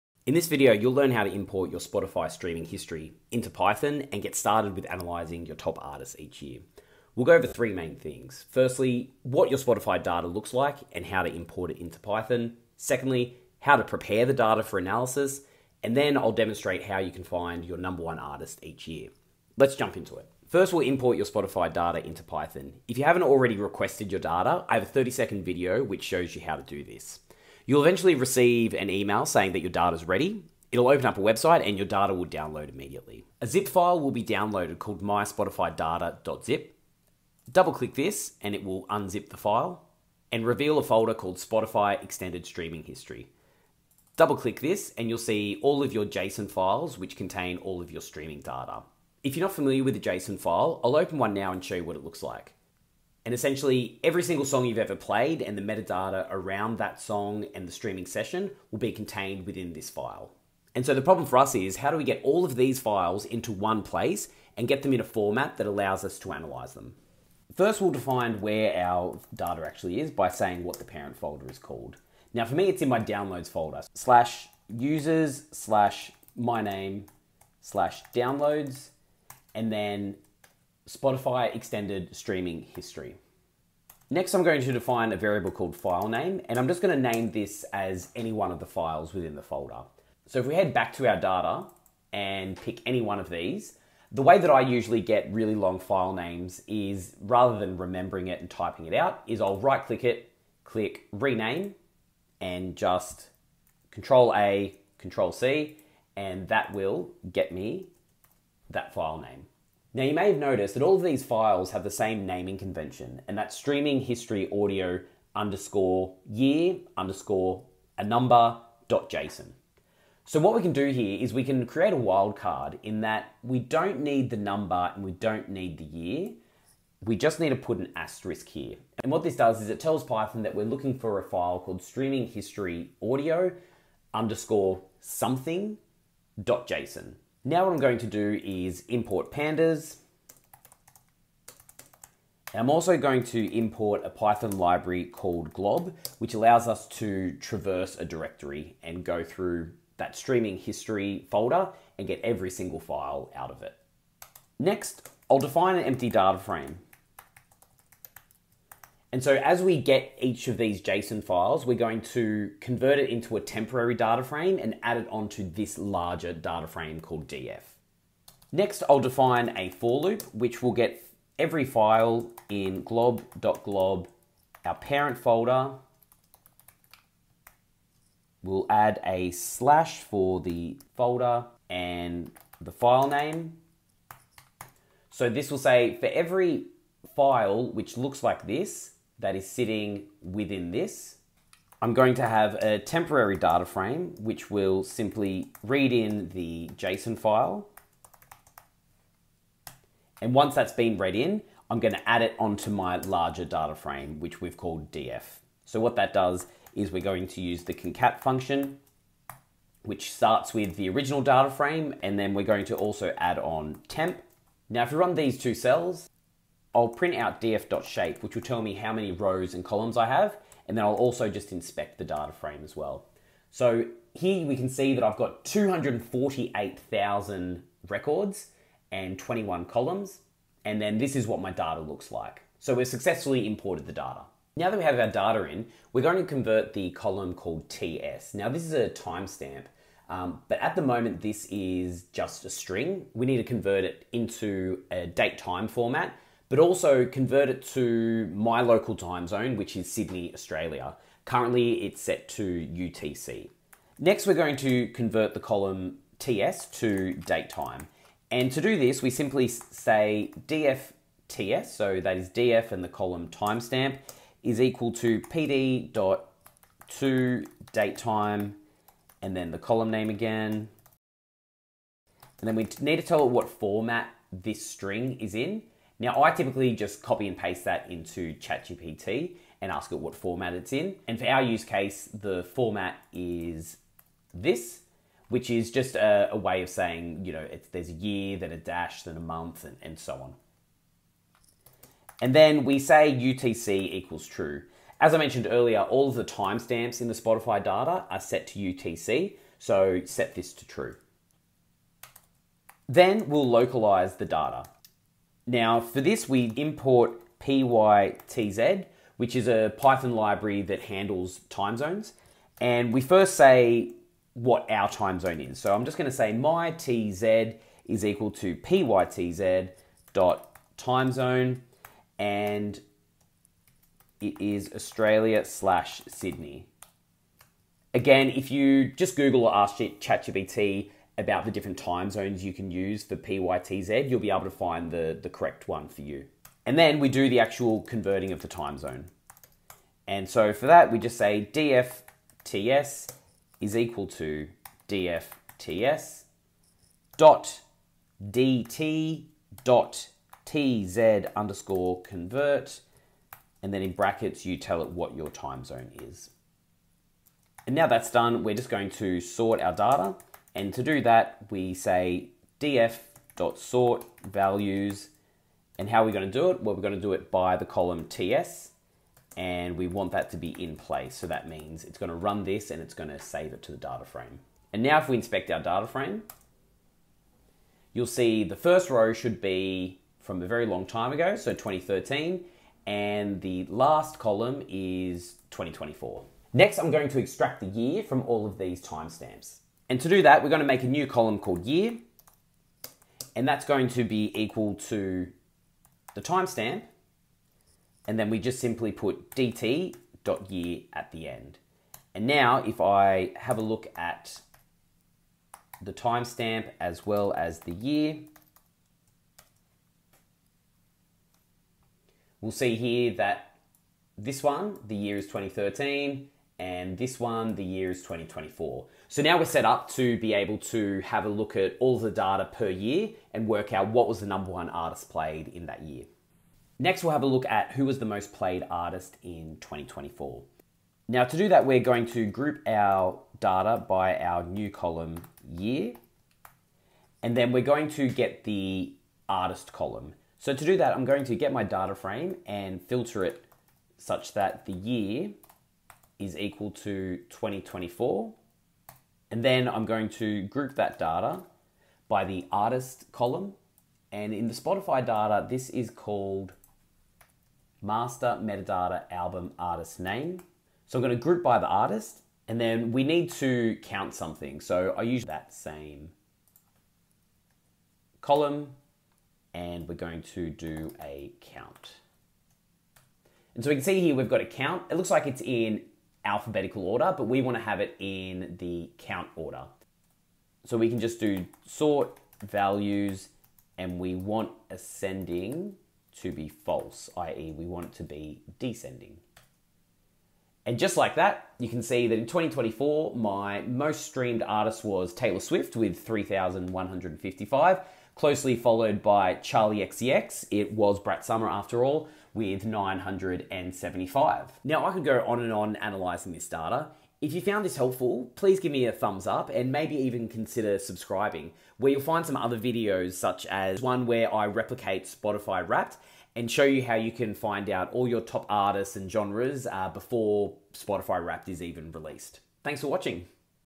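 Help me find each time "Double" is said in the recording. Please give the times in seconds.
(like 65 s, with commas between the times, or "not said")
37 s, 44 s.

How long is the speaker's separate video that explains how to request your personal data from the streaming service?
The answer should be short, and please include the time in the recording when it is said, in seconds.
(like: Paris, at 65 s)
30 seconds, at 24 s.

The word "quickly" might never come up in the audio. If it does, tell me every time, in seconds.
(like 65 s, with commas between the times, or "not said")
not said.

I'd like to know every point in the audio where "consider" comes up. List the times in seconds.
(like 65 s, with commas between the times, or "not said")
510 s.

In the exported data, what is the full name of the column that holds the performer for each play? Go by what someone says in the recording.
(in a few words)
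master metadata album artist name.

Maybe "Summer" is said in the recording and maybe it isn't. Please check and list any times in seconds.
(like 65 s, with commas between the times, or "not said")
501 s.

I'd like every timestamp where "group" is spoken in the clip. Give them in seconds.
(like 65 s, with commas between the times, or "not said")
432 s, 450 s, 461 s.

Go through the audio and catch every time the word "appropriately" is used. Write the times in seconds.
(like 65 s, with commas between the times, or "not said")
not said.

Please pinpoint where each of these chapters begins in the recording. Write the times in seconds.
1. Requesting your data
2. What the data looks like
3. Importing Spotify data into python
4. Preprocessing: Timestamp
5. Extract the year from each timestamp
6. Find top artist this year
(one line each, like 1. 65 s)
1. 20 s
2. 33 s
3. 67 s
4. 253 s
5. 386 s
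6. 427 s.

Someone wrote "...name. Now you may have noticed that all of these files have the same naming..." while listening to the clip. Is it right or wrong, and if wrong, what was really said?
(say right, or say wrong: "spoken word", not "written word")
right.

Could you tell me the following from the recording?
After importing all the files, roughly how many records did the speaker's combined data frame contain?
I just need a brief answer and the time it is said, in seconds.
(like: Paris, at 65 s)
248,000, at 225 s.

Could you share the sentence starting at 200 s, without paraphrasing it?
And once that's been read in, I'm gonna add it onto my larger data frame, which we've called df.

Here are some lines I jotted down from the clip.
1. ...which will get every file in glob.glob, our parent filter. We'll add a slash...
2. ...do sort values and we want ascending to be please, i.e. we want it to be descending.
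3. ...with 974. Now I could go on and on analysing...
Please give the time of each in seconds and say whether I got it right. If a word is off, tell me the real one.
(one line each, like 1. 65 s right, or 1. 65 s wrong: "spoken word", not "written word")
1. 170 s wrong: "folder", not "filter"
2. 481 s wrong: "false", not "please"
3. 502 s wrong: "975", not "974".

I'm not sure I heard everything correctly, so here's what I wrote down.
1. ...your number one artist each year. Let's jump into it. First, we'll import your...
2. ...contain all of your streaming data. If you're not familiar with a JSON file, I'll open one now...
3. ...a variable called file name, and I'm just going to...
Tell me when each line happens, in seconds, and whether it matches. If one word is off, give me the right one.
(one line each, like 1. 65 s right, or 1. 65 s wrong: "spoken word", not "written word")
1. 17 s right
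2. 47 s right
3. 85 s right.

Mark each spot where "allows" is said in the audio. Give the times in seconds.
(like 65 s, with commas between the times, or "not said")
65 s, 146 s.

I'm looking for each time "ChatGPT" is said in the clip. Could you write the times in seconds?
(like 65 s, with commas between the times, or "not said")
278 s, 329 s.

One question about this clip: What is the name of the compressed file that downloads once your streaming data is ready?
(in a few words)
myspotifydata.zip.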